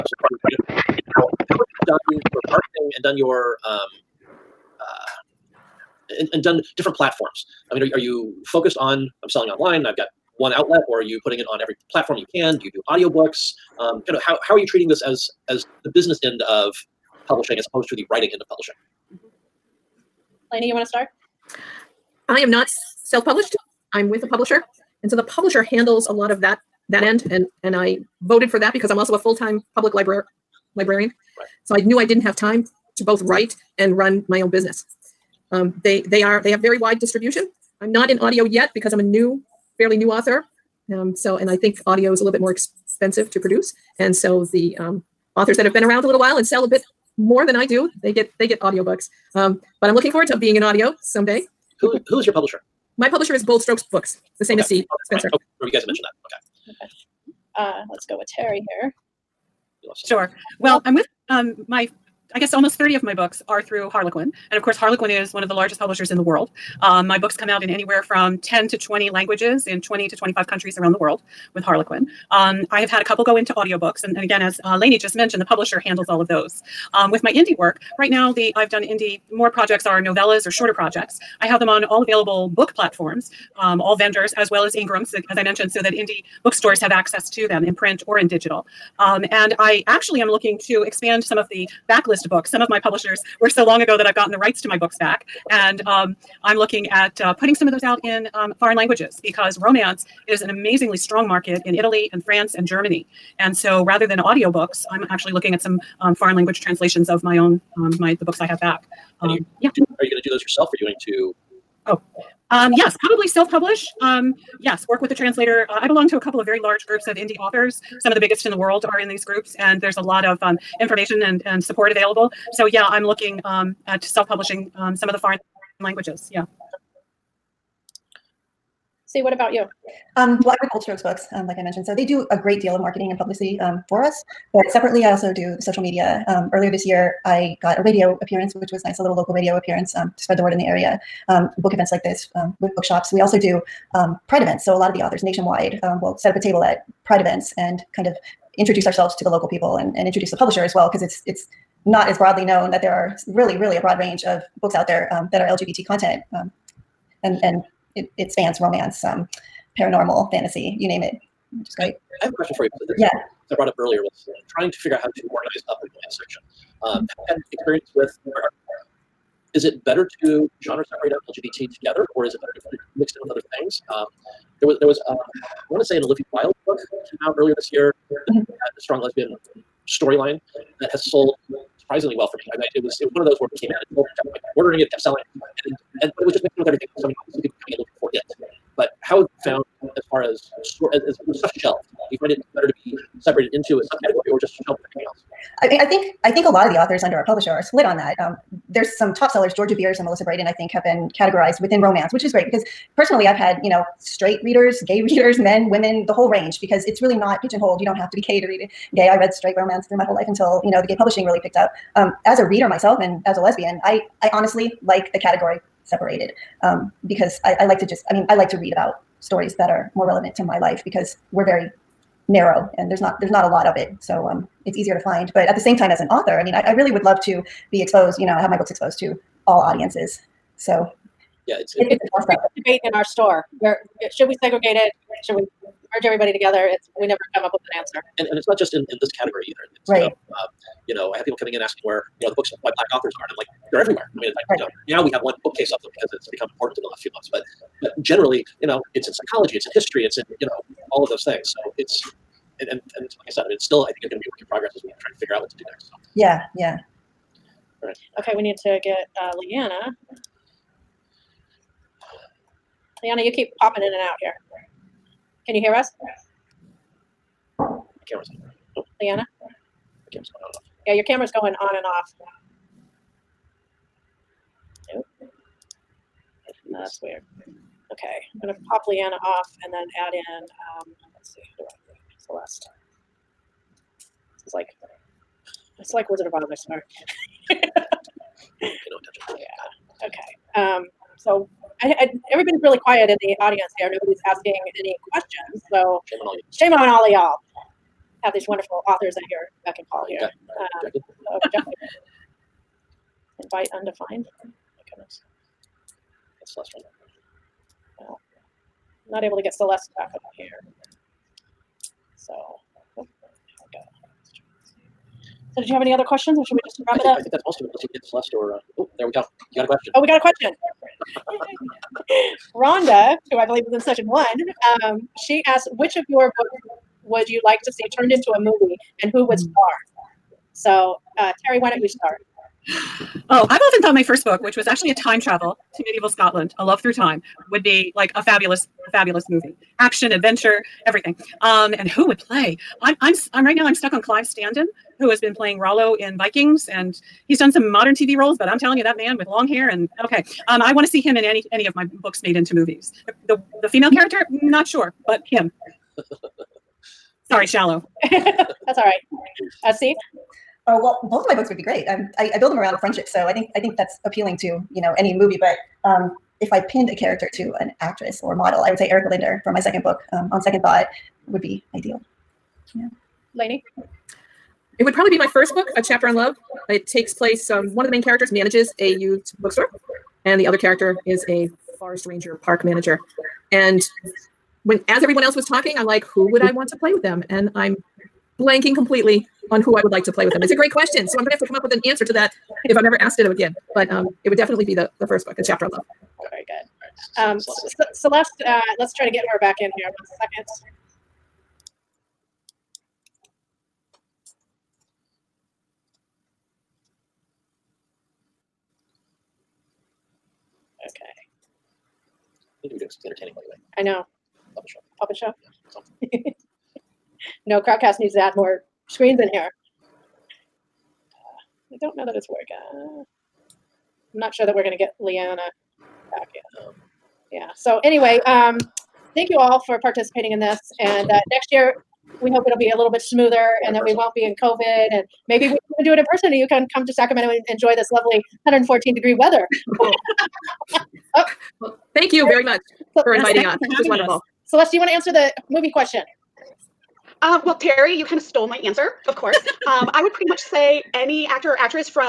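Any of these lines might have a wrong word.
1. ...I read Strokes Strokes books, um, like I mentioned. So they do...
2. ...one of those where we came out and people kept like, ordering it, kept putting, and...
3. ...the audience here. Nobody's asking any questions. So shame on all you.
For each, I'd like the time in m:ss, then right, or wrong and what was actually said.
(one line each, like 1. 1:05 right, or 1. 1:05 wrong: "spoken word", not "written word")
1. 2:10 wrong: "Bold", not "Strokes"
2. 3:03 wrong: "selling", not "putting"
3. 4:53 right.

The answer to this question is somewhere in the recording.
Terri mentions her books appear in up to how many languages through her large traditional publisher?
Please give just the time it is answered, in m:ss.
1:08.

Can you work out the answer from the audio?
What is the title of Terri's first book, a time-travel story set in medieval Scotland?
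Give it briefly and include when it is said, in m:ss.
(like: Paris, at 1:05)
A Love Through Time, at 5:36.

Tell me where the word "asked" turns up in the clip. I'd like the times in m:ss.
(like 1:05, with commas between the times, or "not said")
5:25, 6:33.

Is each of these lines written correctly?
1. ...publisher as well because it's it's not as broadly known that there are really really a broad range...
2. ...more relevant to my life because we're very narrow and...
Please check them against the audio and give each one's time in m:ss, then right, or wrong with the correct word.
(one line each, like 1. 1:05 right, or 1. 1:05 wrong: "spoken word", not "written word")
1. 2:30 right
2. 3:39 right.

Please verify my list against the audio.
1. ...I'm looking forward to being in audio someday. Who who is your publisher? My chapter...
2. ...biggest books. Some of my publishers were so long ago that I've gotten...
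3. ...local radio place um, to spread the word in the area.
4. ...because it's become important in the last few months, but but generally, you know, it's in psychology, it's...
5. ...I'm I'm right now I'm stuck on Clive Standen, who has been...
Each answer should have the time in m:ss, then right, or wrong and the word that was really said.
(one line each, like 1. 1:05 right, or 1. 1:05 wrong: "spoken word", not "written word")
1. 0:49 wrong: "publisher", not "chapter"
2. 1:31 wrong: "backlist", not "biggest"
3. 2:19 wrong: "appearance", not "place"
4. 4:05 right
5. 5:43 right.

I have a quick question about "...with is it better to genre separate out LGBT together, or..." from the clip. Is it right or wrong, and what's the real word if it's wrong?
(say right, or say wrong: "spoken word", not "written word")
right.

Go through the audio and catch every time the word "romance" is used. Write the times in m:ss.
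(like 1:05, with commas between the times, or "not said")
1:39, 2:38, 3:21, 3:29.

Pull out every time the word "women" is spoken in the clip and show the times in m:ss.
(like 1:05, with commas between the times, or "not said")
3:25.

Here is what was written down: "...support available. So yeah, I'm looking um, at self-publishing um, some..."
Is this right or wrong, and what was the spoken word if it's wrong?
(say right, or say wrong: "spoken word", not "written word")
right.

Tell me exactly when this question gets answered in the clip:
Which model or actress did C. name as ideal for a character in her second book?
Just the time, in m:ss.
6:08.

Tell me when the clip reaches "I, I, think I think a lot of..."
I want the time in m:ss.
3:15.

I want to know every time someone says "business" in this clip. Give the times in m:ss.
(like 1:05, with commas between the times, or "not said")
0:15, 0:34.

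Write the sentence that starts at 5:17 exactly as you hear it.
Let's see if we get Celeste or.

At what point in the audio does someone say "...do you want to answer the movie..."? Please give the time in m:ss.
7:24.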